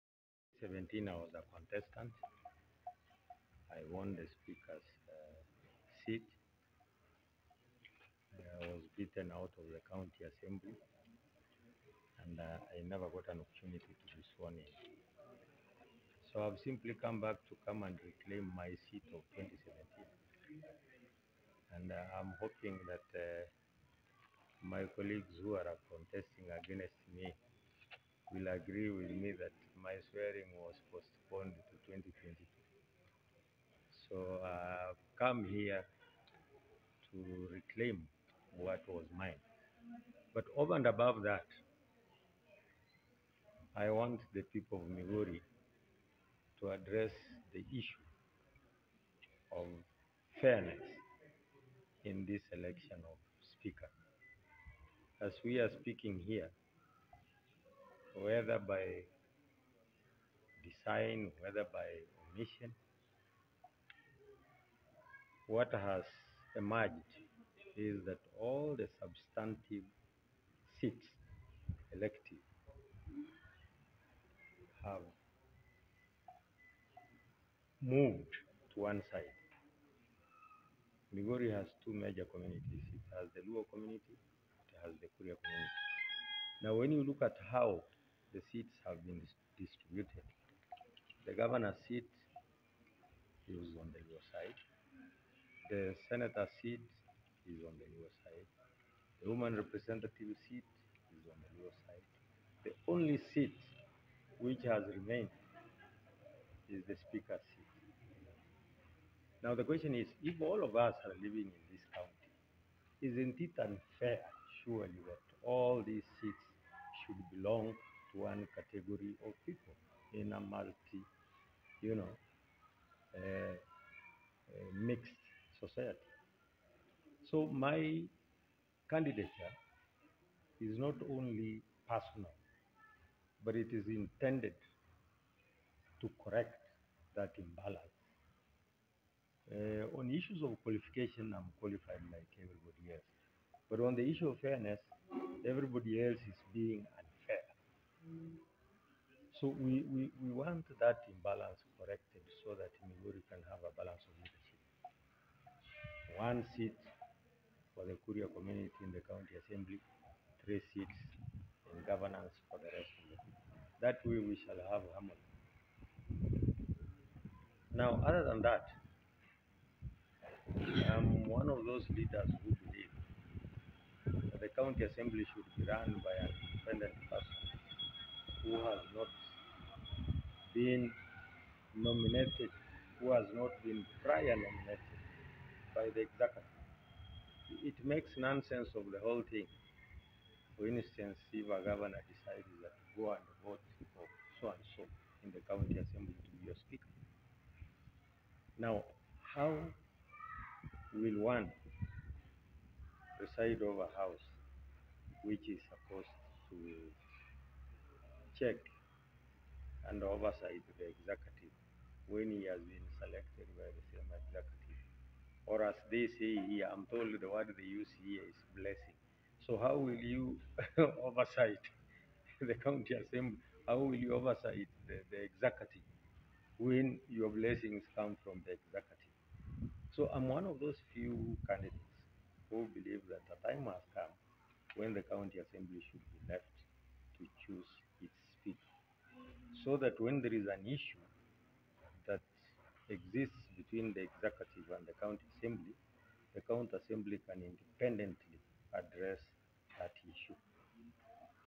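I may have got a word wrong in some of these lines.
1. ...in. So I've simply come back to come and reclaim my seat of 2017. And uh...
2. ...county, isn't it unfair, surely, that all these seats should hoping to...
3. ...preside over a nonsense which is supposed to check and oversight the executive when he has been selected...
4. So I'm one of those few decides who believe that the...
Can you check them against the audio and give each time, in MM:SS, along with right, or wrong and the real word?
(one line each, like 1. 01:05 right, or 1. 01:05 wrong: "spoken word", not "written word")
1. 00:14 right
2. 01:51 wrong: "belong", not "hoping"
3. 03:23 wrong: "house", not "nonsense"
4. 03:49 wrong: "candidates", not "decides".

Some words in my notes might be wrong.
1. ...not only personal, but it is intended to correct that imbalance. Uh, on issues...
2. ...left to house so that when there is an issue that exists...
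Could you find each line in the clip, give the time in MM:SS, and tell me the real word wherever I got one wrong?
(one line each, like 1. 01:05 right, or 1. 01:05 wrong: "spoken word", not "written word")
1. 02:10 right
2. 03:56 wrong: "choose", not "house".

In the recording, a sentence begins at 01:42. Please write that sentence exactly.
The only seat which has remained is the speaker's seat.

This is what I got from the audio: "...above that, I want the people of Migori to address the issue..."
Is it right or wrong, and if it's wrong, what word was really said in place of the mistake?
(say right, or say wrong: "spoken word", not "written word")
right.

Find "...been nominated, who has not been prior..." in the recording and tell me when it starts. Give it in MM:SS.
03:00.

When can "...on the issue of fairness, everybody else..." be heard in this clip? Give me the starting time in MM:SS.
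02:23.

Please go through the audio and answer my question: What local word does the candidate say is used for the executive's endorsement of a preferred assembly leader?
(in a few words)
blessing.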